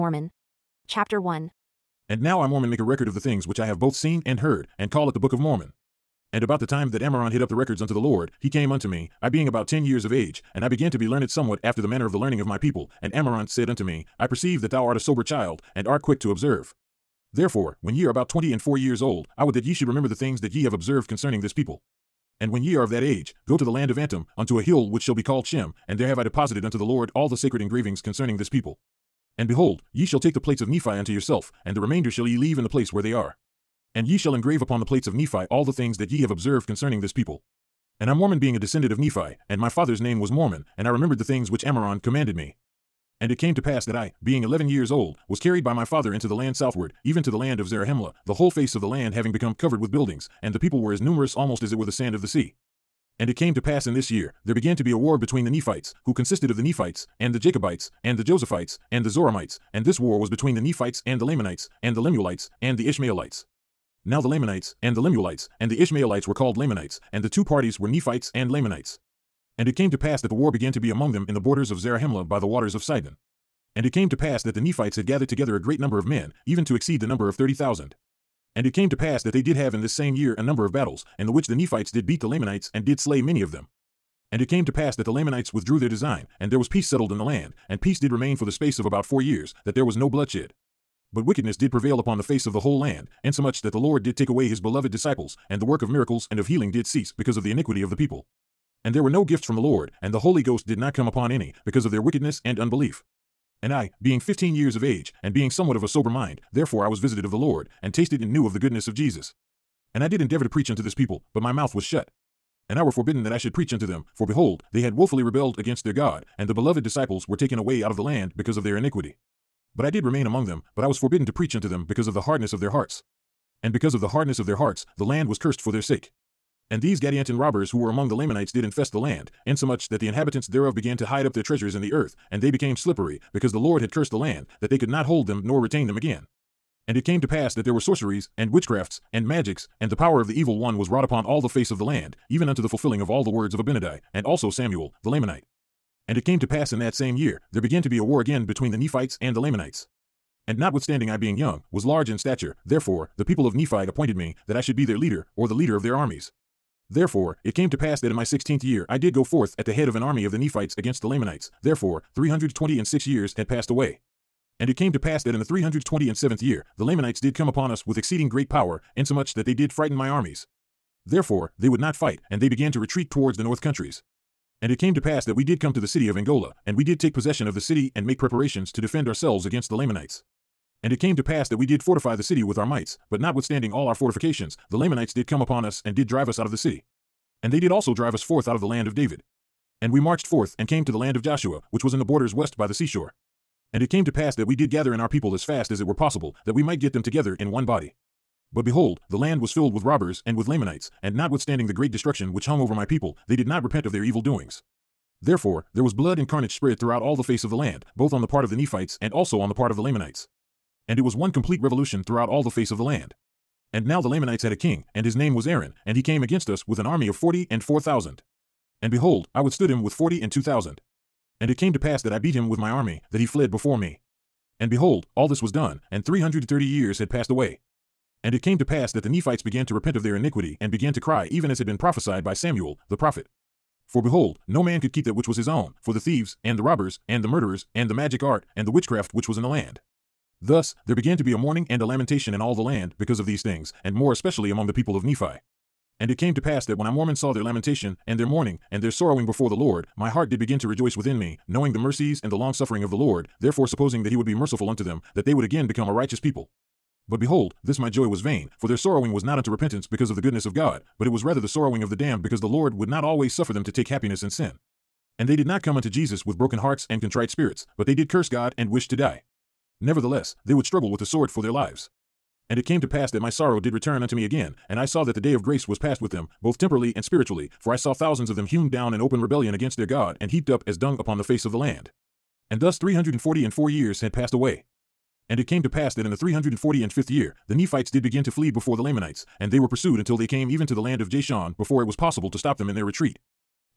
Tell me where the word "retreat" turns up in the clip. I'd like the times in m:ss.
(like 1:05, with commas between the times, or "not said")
2:52, 4:52.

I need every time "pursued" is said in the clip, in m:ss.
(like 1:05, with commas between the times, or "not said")
4:49.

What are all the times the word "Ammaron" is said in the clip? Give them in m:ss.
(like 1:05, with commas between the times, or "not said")
0:06, 0:13, 0:41.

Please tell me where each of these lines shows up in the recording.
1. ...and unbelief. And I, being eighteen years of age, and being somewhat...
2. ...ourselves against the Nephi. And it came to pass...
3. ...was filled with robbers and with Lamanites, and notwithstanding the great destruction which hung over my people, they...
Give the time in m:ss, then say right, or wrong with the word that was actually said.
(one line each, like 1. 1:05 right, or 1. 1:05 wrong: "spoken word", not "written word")
1. 1:42 wrong: "fifteen", not "eighteen"
2. 2:59 wrong: "Lamanites", not "Nephi"
3. 3:19 right.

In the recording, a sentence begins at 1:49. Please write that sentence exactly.
And I did endeavor to preach unto this people, but my mouth was shut.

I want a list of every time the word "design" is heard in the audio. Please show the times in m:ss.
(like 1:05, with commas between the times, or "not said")
1:25.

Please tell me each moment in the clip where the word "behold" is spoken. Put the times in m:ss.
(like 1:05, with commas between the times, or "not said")
0:29, 1:54, 3:18, 3:38, 3:44, 3:54, 4:17.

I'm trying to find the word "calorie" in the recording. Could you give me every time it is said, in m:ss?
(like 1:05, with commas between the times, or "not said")
not said.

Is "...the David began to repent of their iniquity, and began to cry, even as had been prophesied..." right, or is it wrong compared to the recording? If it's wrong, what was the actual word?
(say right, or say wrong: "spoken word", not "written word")
wrong: "Nephites", not "David".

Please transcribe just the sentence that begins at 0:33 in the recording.
And ye shall engrave upon the plates of Nephi all the things that ye have observed concerning this people.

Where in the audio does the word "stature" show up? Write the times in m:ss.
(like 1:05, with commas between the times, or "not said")
2:32.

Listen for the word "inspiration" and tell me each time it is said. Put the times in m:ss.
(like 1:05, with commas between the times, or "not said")
not said.